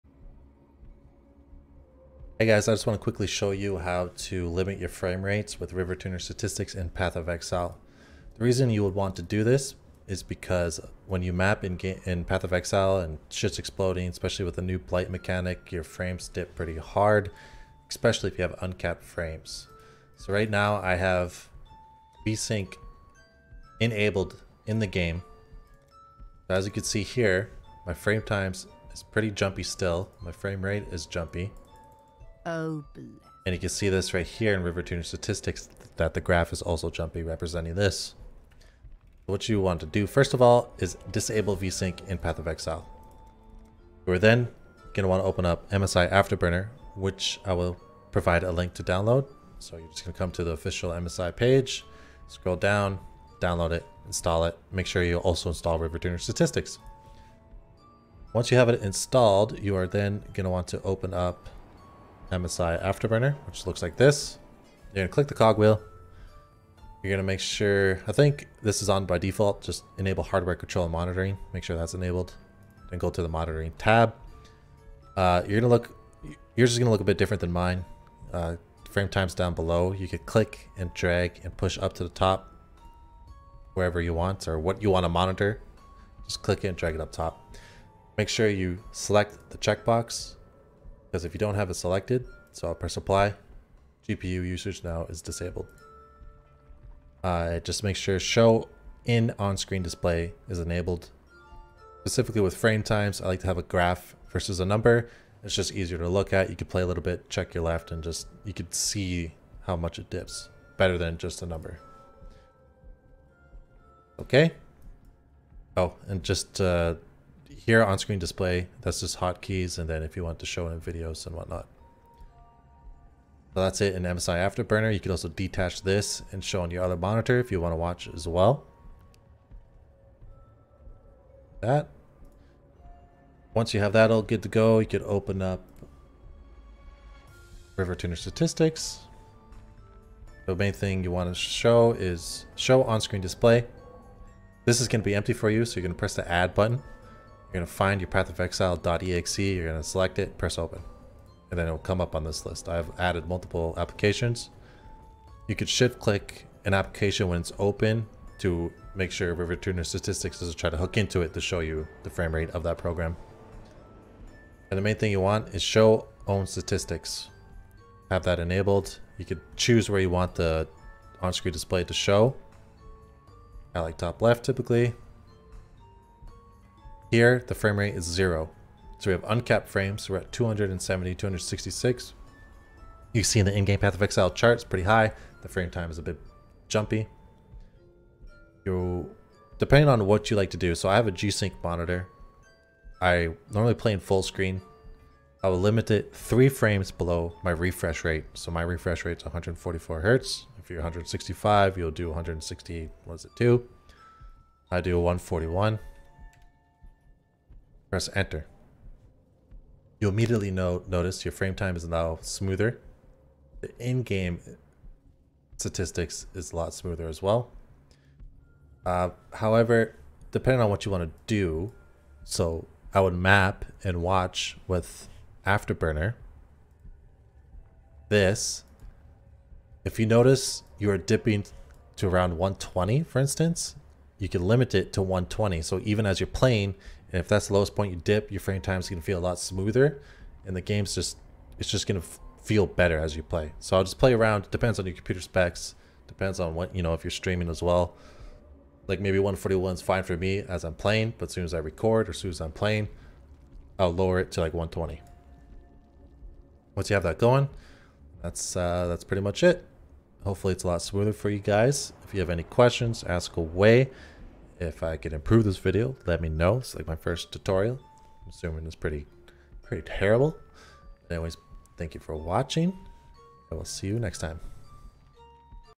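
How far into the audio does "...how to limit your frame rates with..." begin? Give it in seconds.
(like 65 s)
3 s.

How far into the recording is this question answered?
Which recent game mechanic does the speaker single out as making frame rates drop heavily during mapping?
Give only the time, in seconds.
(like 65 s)
14 s.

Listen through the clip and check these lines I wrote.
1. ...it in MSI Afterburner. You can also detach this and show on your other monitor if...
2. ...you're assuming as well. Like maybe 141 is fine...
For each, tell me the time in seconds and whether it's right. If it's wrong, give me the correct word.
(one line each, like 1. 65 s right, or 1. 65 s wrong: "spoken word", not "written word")
1. 123 s right
2. 247 s wrong: "streaming", not "assuming".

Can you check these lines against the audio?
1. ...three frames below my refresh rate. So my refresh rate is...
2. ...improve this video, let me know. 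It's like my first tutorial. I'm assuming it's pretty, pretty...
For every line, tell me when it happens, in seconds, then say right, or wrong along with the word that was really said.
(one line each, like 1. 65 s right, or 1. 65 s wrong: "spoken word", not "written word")
1. 196 s right
2. 265 s right.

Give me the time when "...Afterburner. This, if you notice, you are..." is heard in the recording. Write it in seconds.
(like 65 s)
225 s.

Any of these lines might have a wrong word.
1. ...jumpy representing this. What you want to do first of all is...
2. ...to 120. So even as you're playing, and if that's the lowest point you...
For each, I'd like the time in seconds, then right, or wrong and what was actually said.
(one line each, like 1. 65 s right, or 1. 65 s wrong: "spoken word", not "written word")
1. 36 s right
2. 234 s right.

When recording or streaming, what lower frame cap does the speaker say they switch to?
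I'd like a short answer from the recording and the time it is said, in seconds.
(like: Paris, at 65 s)
120, at 254 s.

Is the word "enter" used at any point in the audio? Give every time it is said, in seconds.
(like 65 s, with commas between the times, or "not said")
208 s.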